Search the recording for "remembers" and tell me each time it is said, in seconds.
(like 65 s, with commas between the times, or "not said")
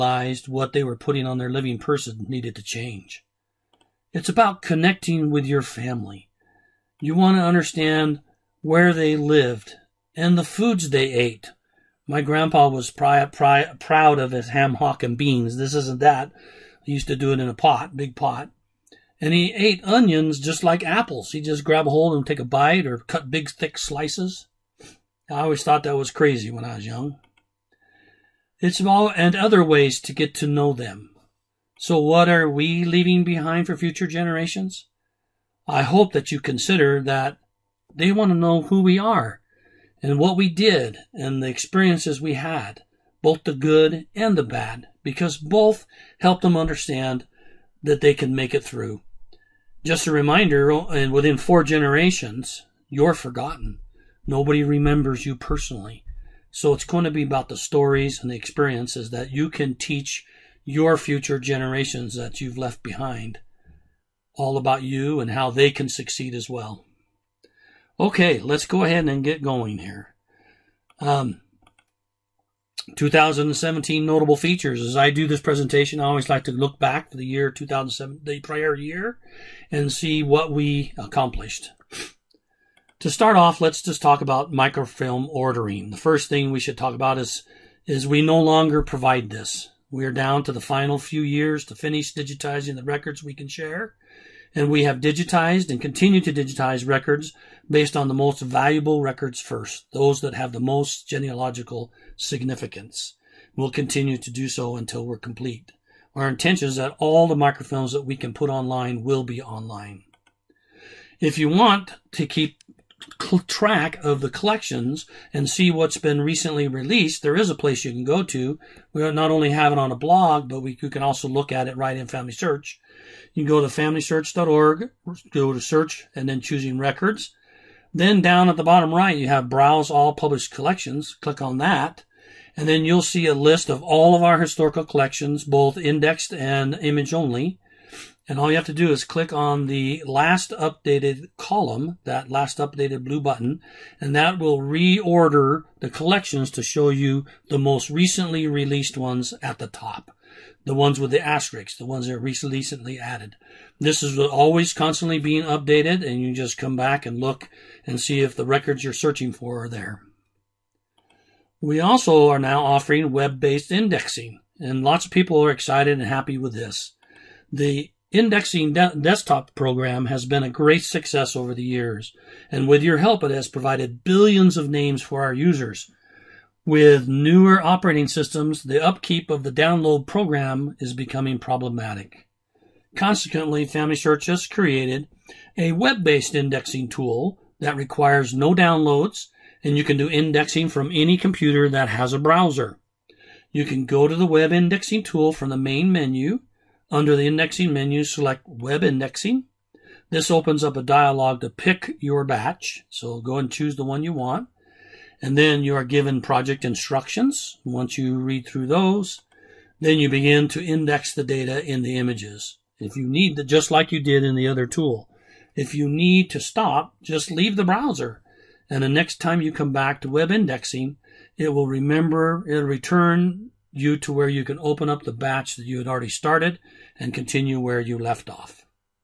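54 s, 221 s.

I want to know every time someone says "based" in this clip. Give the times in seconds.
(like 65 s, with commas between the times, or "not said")
97 s, 163 s, 185 s.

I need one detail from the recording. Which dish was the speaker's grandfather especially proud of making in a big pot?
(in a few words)
ham hock and beans.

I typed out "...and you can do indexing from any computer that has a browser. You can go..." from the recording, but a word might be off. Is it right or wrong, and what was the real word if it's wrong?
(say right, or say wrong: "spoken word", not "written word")
right.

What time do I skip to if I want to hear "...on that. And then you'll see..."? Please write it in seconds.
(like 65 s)
131 s.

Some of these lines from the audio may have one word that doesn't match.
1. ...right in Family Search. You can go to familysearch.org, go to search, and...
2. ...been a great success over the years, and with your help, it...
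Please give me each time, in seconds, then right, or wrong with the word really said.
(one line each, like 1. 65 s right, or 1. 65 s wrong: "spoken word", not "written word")
1. 121 s right
2. 170 s right.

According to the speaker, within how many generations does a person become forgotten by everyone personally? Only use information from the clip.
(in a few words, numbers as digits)
4.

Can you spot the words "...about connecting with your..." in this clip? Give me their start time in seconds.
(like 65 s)
4 s.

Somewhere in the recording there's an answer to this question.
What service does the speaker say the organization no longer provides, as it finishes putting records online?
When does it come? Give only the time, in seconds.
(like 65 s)
84 s.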